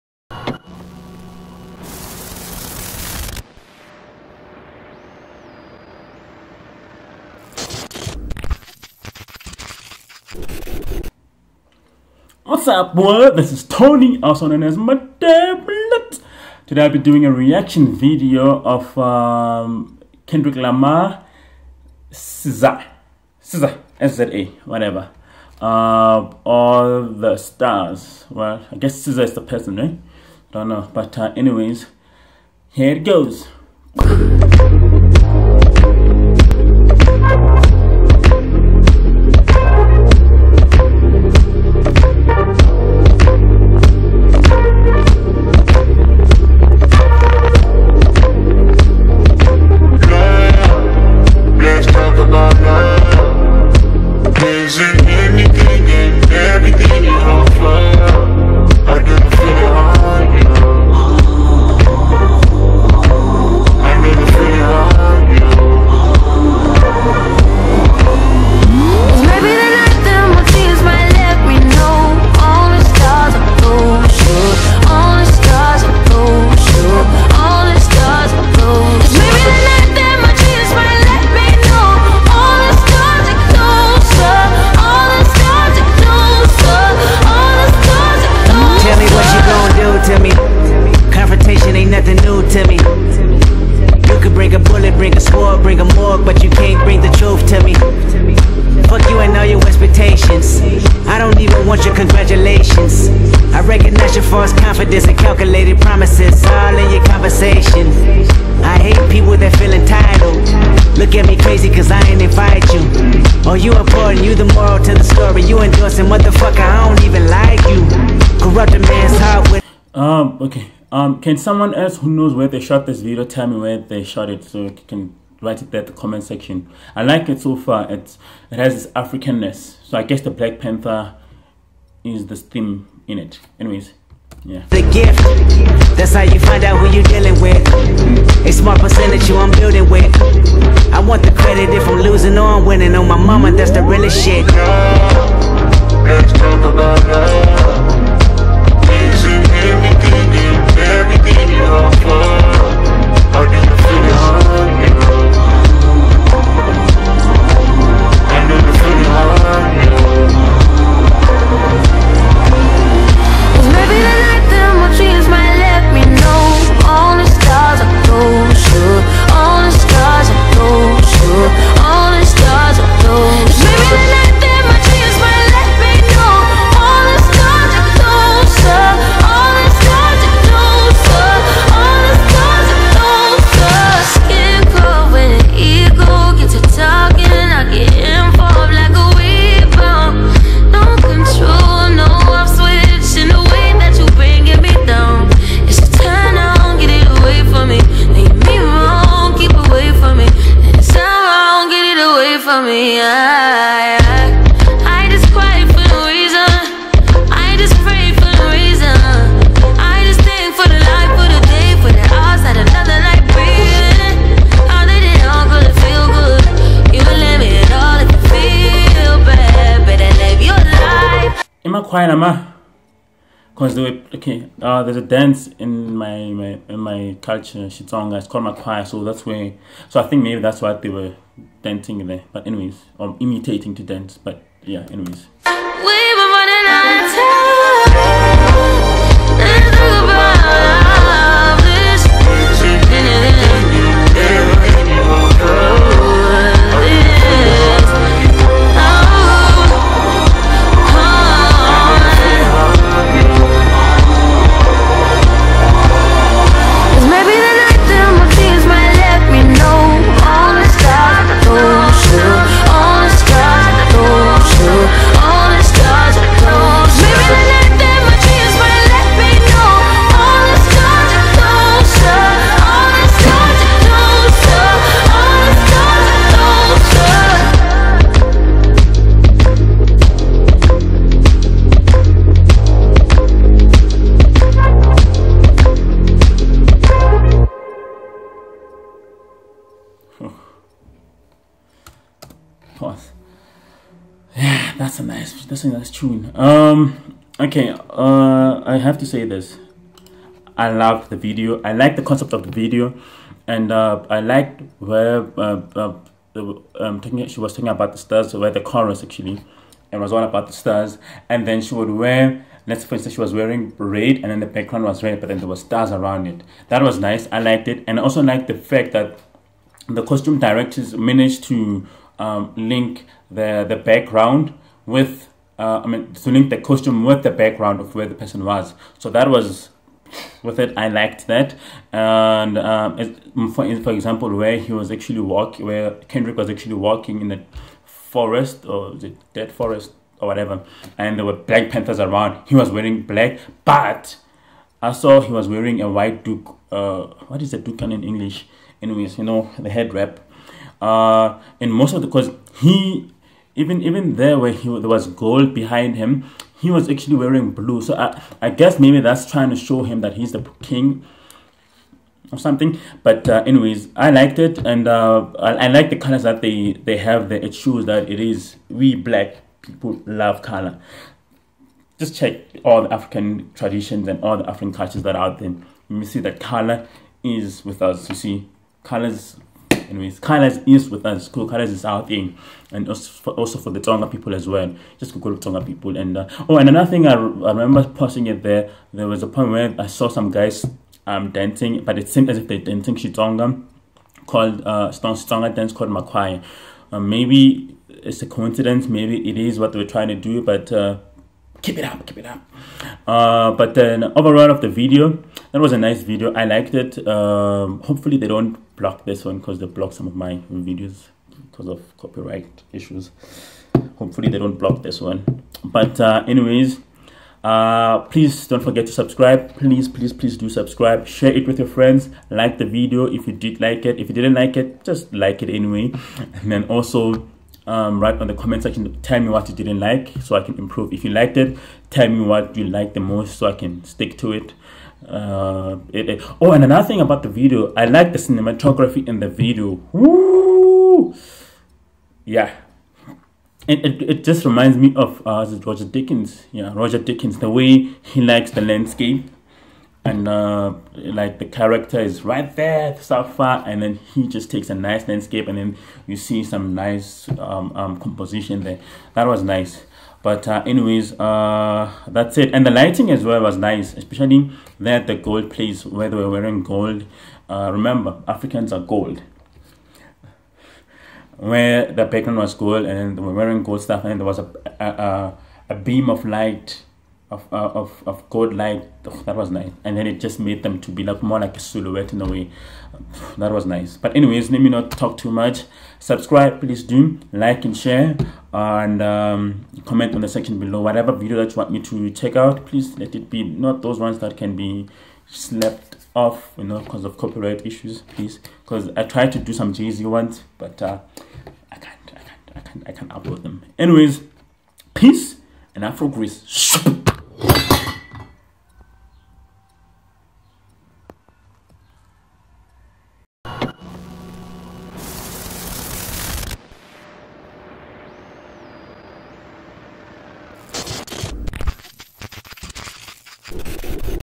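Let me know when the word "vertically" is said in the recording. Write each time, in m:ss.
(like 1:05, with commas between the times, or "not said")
not said.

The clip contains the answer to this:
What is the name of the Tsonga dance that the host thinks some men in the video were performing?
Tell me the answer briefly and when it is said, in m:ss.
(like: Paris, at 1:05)
Makwaya, at 6:35.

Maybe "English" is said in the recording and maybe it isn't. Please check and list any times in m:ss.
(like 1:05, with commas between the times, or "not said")
5:48.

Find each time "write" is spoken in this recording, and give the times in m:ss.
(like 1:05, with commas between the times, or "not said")
2:05, 7:07.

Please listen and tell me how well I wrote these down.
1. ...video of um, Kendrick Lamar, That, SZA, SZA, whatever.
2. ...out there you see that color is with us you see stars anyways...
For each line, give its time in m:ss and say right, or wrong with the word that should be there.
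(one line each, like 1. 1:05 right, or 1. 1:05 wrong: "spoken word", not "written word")
1. 0:17 wrong: "SZA", not "That"
2. 6:15 wrong: "colors", not "stars".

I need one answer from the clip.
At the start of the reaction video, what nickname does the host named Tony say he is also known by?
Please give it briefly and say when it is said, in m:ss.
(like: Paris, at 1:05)
Matablet, at 0:14.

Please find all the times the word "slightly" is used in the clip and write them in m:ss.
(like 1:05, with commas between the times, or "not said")
not said.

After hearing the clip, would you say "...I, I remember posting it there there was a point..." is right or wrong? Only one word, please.
right.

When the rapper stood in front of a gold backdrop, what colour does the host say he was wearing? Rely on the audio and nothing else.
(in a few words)
Blue.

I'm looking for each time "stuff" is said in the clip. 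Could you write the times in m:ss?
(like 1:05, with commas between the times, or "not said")
7:53.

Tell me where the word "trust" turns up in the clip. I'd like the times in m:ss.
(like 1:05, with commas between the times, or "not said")
not said.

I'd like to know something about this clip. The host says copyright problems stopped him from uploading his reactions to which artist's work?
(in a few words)
Jay-Z.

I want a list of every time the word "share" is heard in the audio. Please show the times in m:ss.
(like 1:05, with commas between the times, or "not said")
7:01, 8:07.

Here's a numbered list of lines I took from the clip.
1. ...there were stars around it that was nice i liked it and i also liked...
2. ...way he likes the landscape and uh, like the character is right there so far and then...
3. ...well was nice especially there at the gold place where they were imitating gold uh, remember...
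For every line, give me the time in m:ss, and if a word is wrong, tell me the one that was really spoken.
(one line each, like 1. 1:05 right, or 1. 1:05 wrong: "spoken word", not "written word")
1. 5:15 right
2. 7:27 right
3. 7:43 wrong: "wearing", not "imitating".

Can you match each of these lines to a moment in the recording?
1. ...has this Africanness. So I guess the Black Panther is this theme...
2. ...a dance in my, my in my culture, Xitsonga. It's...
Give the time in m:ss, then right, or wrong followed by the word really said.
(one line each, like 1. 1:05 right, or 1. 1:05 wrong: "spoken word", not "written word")
1. 2:08 right
2. 3:44 right.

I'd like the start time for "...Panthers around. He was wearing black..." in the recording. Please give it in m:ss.
5:41.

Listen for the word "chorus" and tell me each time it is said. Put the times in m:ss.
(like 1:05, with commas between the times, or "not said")
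5:08.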